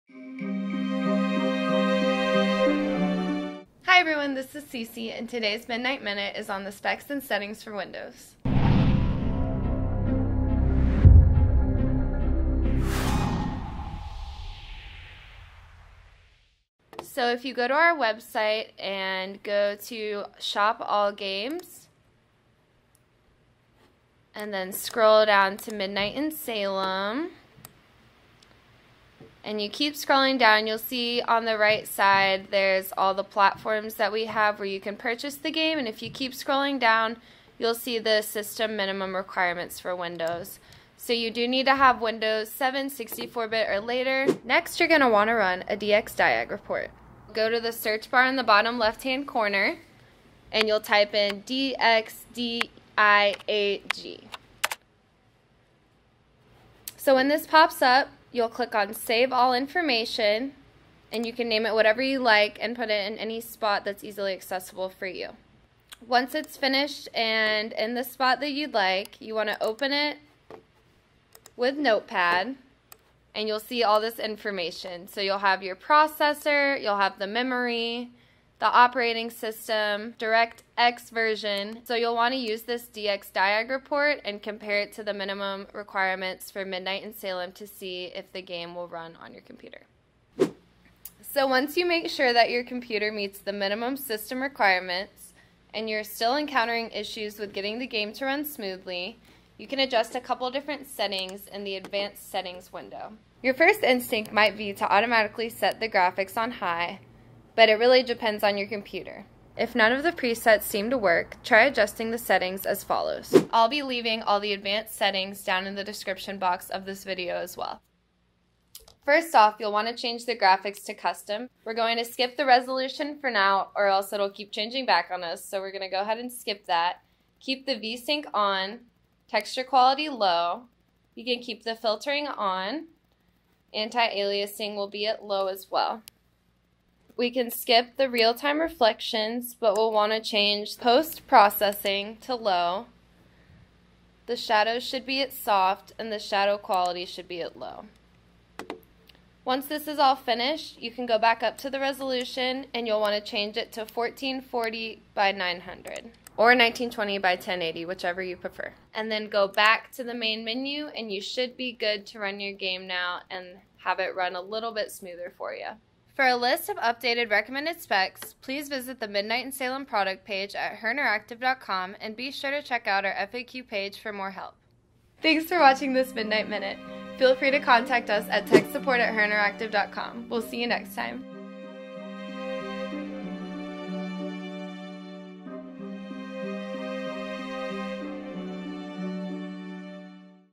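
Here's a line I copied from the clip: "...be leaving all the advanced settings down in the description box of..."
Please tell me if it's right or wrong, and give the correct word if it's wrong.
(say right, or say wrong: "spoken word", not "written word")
right.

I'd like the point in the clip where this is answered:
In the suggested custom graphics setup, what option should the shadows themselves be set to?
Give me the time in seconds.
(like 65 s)
145 s.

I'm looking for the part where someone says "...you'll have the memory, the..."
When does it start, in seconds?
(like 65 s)
76 s.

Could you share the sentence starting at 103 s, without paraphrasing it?
Your first instinct might be to automatically set the graphics on high, but it really depends on your computer.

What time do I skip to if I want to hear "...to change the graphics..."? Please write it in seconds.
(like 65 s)
119 s.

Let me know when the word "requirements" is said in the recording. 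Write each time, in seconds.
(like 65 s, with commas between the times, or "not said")
39 s, 85 s, 94 s.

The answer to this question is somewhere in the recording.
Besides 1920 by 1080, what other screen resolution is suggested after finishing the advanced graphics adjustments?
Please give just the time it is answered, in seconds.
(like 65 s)
153 s.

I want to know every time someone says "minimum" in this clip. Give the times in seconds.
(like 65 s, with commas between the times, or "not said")
38 s, 85 s, 93 s.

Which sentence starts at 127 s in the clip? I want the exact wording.
Keep the VSync on, texture quality low.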